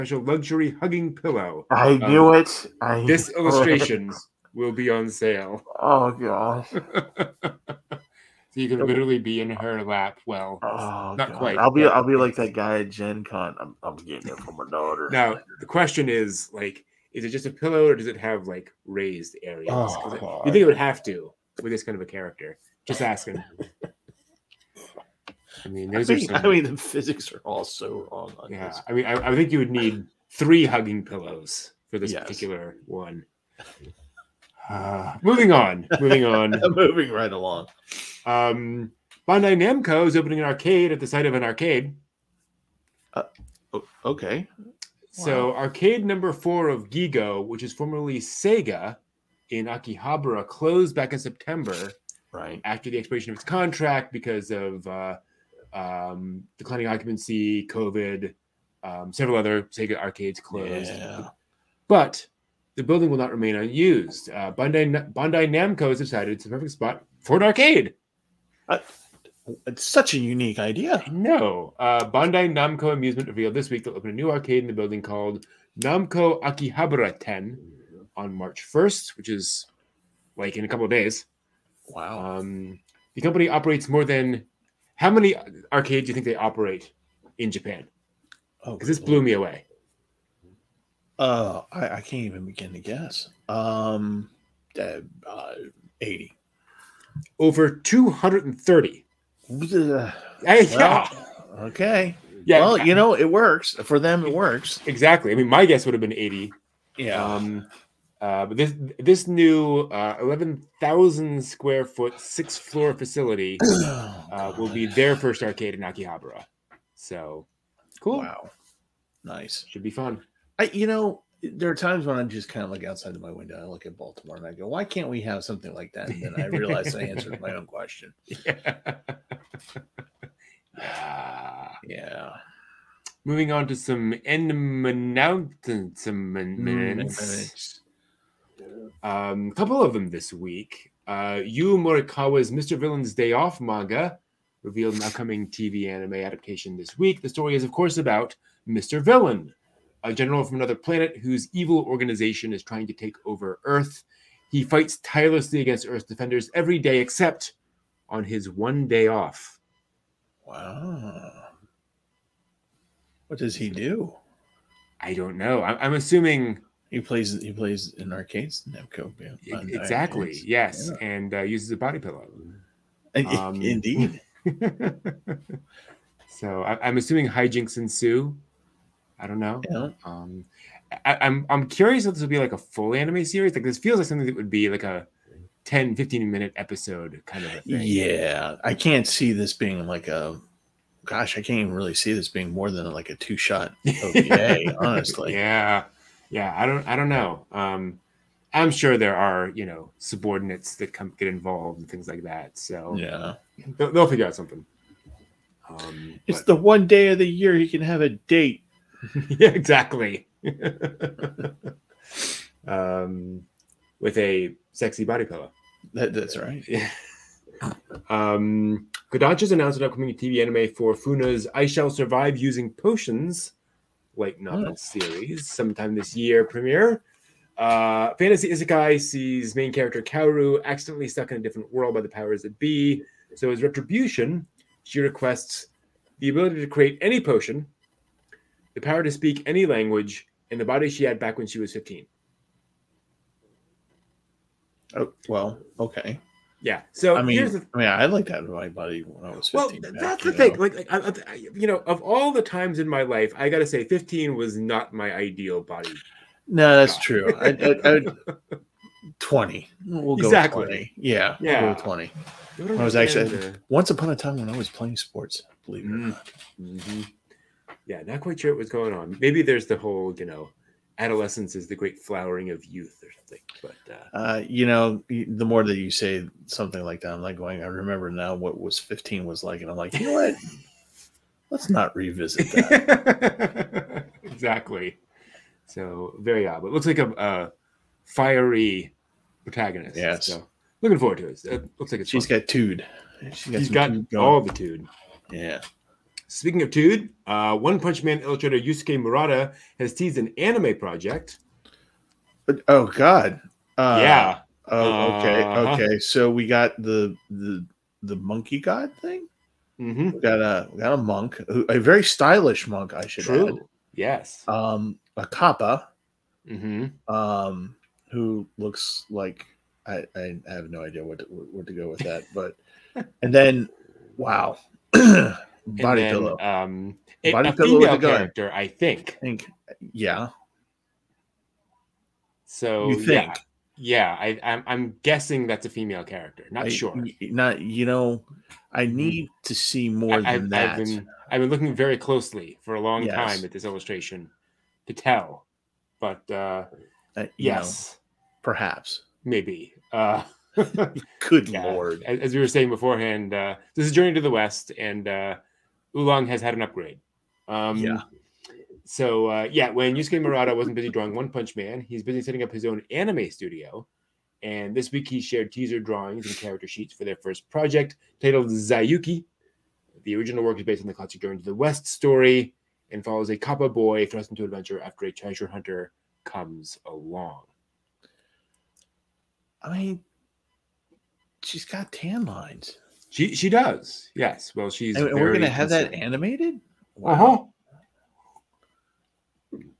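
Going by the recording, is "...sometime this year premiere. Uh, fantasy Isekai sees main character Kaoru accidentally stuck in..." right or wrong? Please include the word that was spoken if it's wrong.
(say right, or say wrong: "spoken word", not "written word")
right.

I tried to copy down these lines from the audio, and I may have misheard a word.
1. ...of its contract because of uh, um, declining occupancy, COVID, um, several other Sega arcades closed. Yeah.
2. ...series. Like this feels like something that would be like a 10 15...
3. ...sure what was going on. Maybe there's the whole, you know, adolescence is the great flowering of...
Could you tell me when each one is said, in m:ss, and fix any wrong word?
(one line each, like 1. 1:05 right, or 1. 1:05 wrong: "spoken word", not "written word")
1. 0:53 right
2. 3:03 right
3. 4:28 right.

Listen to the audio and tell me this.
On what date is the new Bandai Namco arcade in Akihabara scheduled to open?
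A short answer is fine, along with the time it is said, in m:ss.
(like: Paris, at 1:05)
March 1st, at 1:18.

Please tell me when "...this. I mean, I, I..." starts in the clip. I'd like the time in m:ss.
0:28.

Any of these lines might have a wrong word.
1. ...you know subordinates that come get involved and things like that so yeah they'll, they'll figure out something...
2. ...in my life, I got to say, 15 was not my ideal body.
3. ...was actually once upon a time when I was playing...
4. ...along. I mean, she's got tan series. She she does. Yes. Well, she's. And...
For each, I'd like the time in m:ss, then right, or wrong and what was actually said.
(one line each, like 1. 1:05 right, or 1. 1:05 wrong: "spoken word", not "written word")
1. 3:19 right
2. 4:12 right
3. 4:22 right
4. 6:16 wrong: "lines", not "series".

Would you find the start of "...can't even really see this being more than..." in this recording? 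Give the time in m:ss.
3:11.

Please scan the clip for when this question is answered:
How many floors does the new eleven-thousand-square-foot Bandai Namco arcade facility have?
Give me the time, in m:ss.
1:52.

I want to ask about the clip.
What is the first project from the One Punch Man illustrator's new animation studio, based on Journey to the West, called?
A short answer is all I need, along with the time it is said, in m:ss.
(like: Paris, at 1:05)
Zayuki, at 6:08.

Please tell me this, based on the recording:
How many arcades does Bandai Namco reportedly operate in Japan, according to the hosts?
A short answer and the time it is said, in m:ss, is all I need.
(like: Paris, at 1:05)
Over 230, at 1:37.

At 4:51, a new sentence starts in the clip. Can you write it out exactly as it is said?
it looks like it's she's fun.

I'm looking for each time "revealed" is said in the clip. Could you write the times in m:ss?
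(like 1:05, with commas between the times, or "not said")
1:13, 2:24.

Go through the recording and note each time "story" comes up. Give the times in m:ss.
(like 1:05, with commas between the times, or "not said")
2:27, 6:11.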